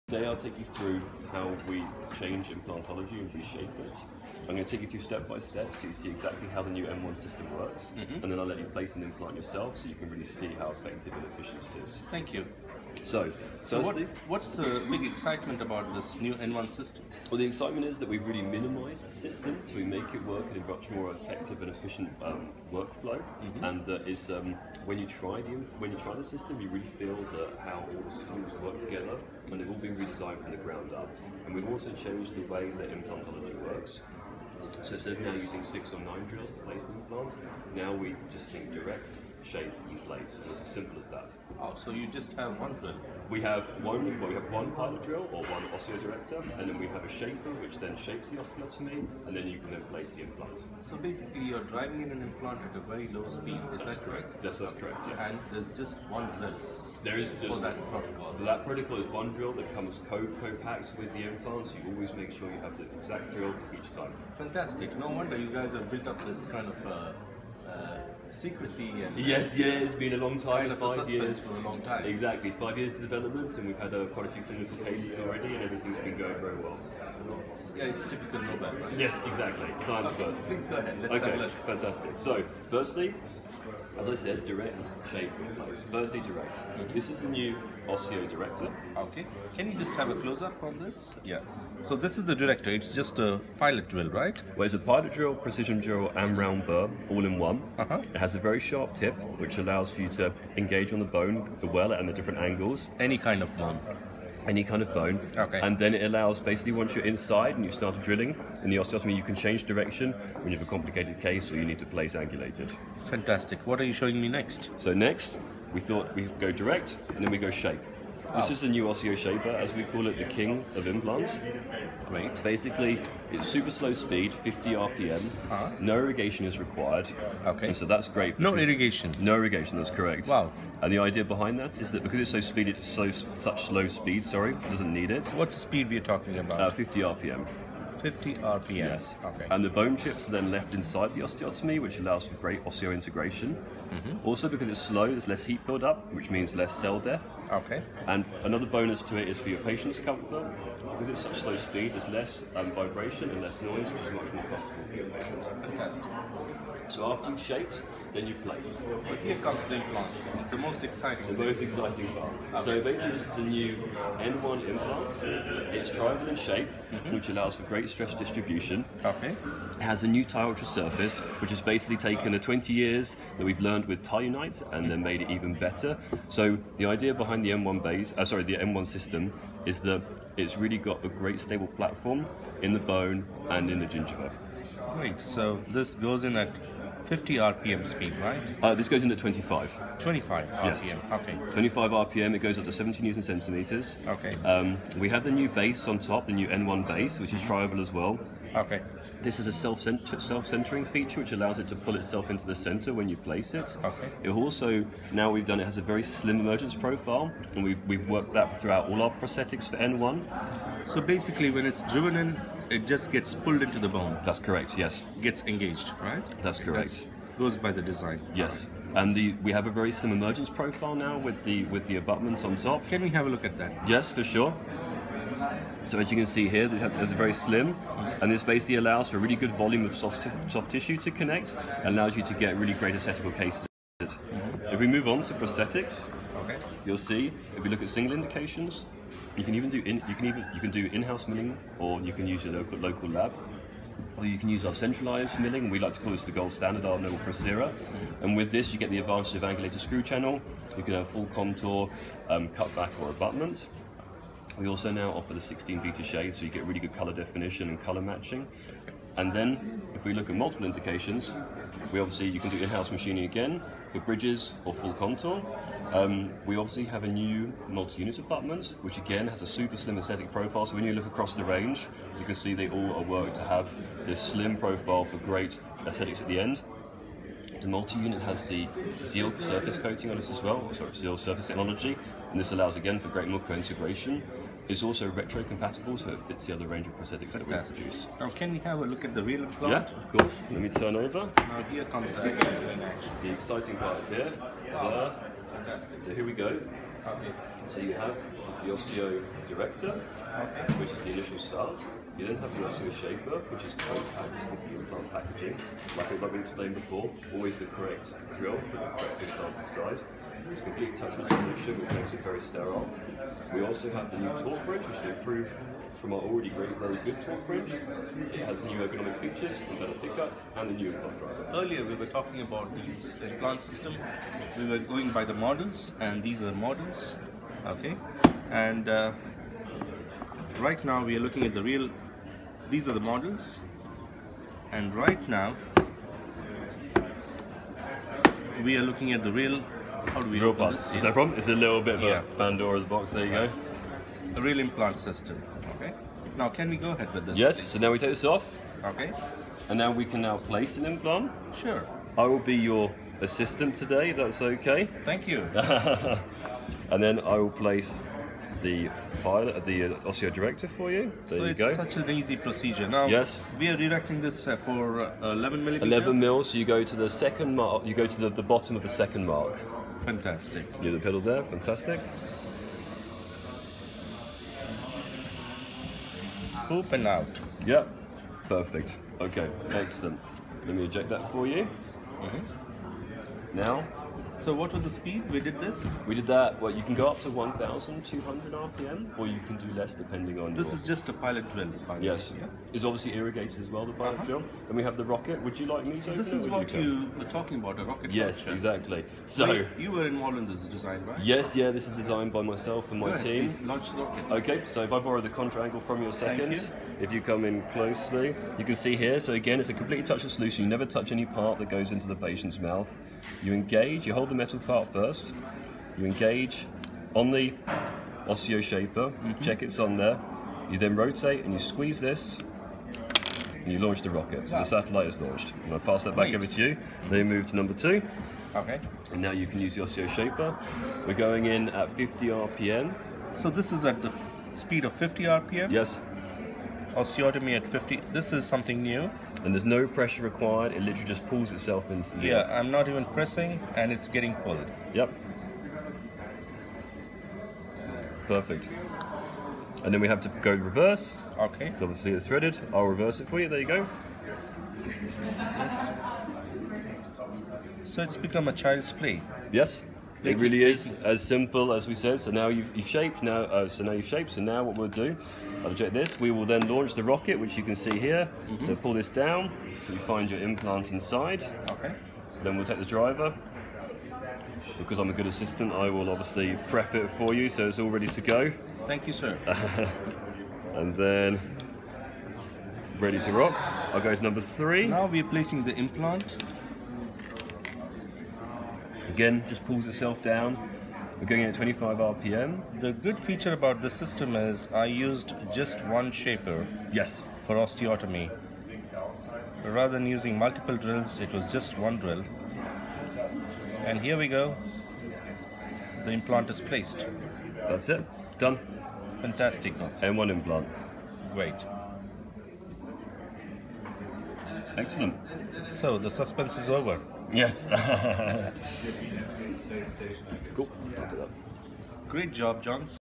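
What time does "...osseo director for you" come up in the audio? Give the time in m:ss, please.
6:00.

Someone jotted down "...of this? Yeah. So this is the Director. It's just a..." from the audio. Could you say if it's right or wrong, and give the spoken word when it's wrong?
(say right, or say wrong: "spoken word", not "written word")
right.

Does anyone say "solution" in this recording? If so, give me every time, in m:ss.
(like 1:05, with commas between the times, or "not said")
5:11, 6:50.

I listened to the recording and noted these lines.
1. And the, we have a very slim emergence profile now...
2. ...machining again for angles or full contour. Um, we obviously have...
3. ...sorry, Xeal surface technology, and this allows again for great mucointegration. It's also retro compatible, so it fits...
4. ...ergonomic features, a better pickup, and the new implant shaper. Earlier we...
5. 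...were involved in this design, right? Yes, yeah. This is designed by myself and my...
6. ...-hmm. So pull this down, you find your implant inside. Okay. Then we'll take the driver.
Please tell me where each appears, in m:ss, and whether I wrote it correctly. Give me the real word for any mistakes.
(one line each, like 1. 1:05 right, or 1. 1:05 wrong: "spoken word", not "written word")
1. 3:39 right
2. 4:22 wrong: "bridges", not "angles"
3. 4:40 right
4. 5:18 wrong: "driver", not "shaper"
5. 6:39 right
6. 7:48 right.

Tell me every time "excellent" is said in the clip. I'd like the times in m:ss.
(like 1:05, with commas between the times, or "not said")
6:19, 8:34.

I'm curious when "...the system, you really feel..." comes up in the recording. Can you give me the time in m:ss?
0:26.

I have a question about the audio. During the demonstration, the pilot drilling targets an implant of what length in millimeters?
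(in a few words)
11 millimeters.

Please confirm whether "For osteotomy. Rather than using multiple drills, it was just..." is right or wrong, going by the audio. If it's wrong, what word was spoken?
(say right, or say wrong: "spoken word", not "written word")
right.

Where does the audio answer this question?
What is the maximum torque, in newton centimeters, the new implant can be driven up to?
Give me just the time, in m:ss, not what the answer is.
3:12.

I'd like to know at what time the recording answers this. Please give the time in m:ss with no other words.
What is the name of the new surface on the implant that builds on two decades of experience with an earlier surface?
2:50.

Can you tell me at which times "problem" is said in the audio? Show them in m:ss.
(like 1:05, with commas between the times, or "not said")
5:41.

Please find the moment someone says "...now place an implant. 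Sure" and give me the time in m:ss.
5:50.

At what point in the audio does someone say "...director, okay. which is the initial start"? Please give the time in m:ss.
4:59.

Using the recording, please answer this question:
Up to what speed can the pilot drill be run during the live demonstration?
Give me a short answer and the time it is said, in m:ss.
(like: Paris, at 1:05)
1,200 RPM, at 6:27.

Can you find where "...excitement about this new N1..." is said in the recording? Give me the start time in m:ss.
0:15.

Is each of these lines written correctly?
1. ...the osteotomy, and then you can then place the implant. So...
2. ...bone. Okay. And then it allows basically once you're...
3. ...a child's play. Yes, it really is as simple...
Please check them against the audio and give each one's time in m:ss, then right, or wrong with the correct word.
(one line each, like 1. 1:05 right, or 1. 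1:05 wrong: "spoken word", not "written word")
1. 0:48 right
2. 1:44 right
3. 7:38 right.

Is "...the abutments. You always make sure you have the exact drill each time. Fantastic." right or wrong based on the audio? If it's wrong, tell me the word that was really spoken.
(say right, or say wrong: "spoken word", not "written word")
wrong: "implants", not "abutments".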